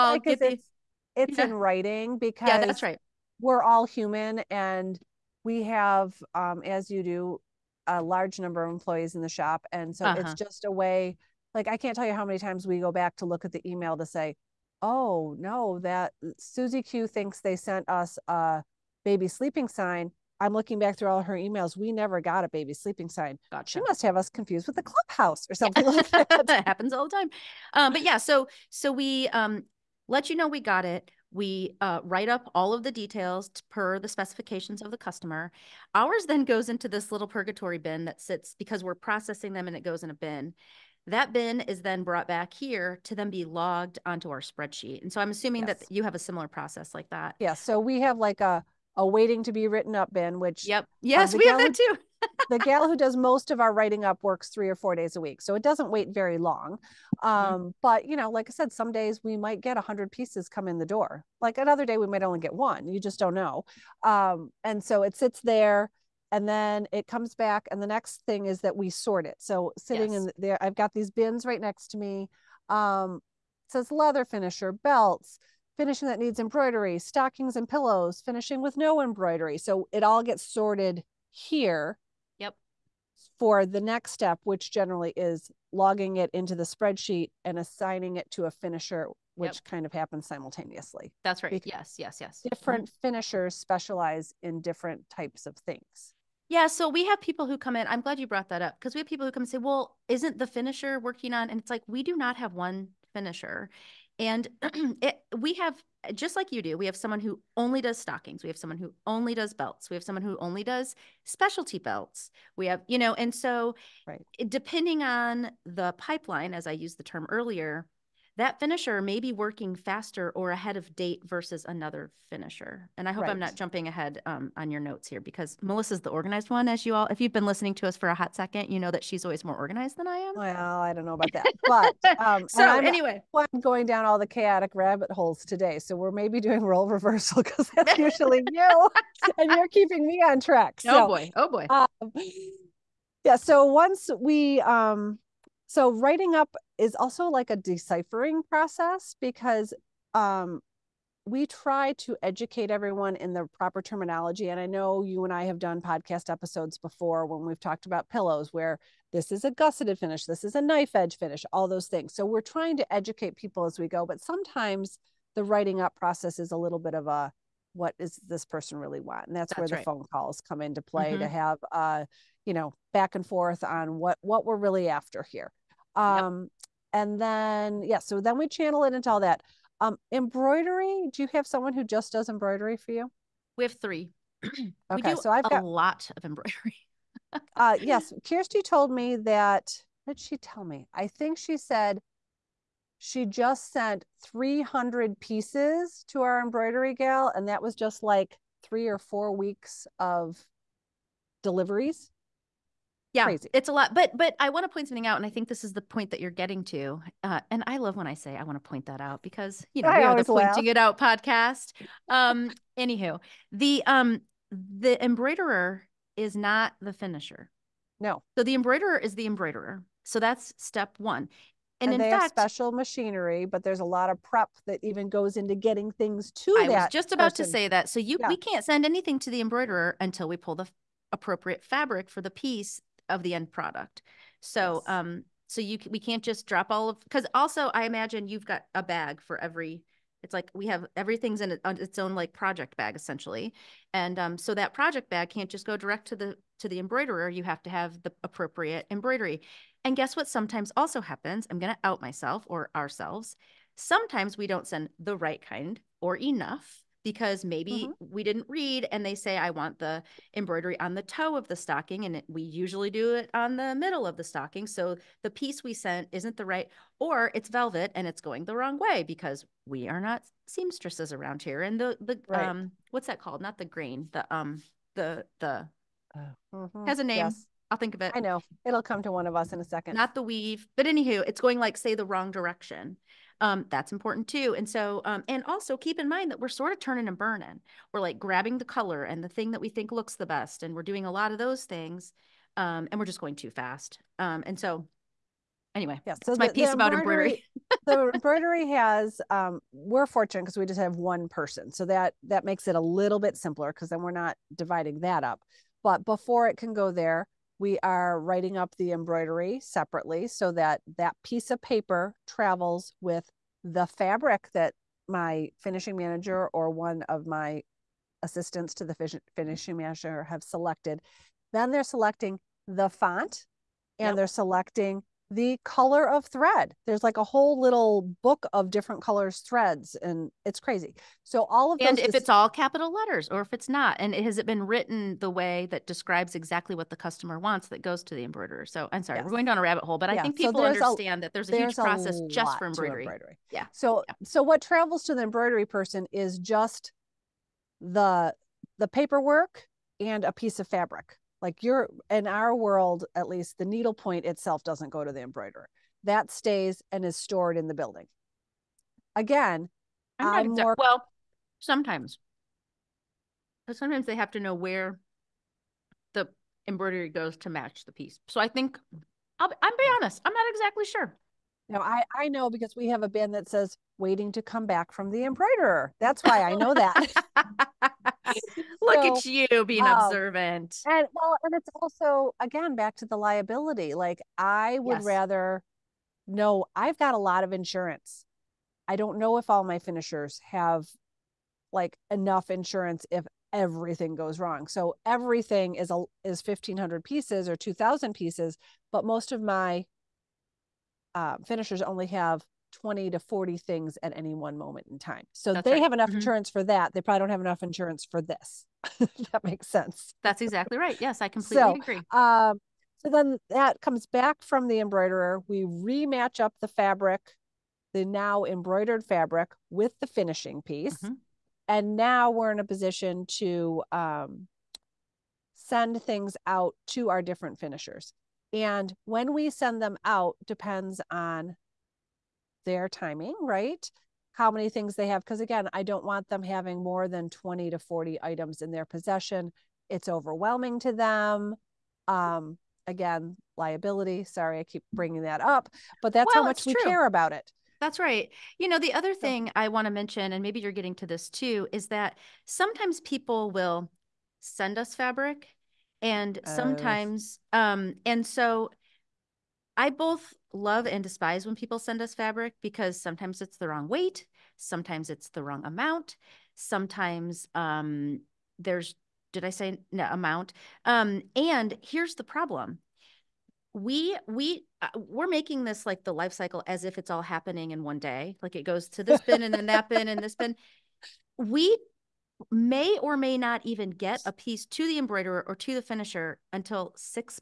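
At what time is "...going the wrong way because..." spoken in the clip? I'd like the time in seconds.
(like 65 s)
268 s.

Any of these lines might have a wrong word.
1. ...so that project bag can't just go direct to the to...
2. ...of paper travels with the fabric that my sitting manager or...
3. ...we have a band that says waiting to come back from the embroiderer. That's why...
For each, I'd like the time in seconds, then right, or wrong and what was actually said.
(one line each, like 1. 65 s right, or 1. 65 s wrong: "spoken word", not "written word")
1. 244 s right
2. 311 s wrong: "finishing", not "sitting"
3. 372 s right.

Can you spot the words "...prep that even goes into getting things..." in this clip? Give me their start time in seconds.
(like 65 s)
224 s.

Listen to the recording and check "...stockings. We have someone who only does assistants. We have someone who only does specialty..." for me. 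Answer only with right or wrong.
wrong.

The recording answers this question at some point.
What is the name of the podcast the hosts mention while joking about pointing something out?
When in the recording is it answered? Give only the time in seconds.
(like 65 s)
210 s.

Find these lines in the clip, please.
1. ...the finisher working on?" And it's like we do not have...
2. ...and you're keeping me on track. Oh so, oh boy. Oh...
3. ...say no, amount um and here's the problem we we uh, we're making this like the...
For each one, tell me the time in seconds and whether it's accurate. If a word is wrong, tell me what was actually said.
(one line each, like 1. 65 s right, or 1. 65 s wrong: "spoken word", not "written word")
1. 100 s right
2. 139 s right
3. 469 s right.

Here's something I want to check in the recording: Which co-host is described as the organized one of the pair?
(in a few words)
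Melissa.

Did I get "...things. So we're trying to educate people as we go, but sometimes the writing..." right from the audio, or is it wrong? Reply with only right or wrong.
right.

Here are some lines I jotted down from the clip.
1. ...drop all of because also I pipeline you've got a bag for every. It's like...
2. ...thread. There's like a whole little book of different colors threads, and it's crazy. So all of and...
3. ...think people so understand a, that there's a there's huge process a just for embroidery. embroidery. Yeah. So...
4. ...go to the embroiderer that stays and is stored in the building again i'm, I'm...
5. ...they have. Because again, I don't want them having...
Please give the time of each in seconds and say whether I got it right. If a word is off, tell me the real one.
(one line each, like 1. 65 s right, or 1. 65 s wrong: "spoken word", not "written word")
1. 236 s wrong: "imagine", not "pipeline"
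2. 326 s right
3. 340 s right
4. 354 s right
5. 434 s right.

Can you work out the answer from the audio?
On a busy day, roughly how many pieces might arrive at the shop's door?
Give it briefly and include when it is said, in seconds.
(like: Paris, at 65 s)
100, at 59 s.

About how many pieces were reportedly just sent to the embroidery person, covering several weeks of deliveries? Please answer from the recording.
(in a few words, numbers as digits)
300.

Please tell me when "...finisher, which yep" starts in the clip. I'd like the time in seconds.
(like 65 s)
88 s.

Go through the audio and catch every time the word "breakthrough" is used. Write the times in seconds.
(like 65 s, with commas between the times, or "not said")
not said.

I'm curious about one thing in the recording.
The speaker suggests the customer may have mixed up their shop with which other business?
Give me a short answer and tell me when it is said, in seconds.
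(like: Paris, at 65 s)
the clubhouse, at 24 s.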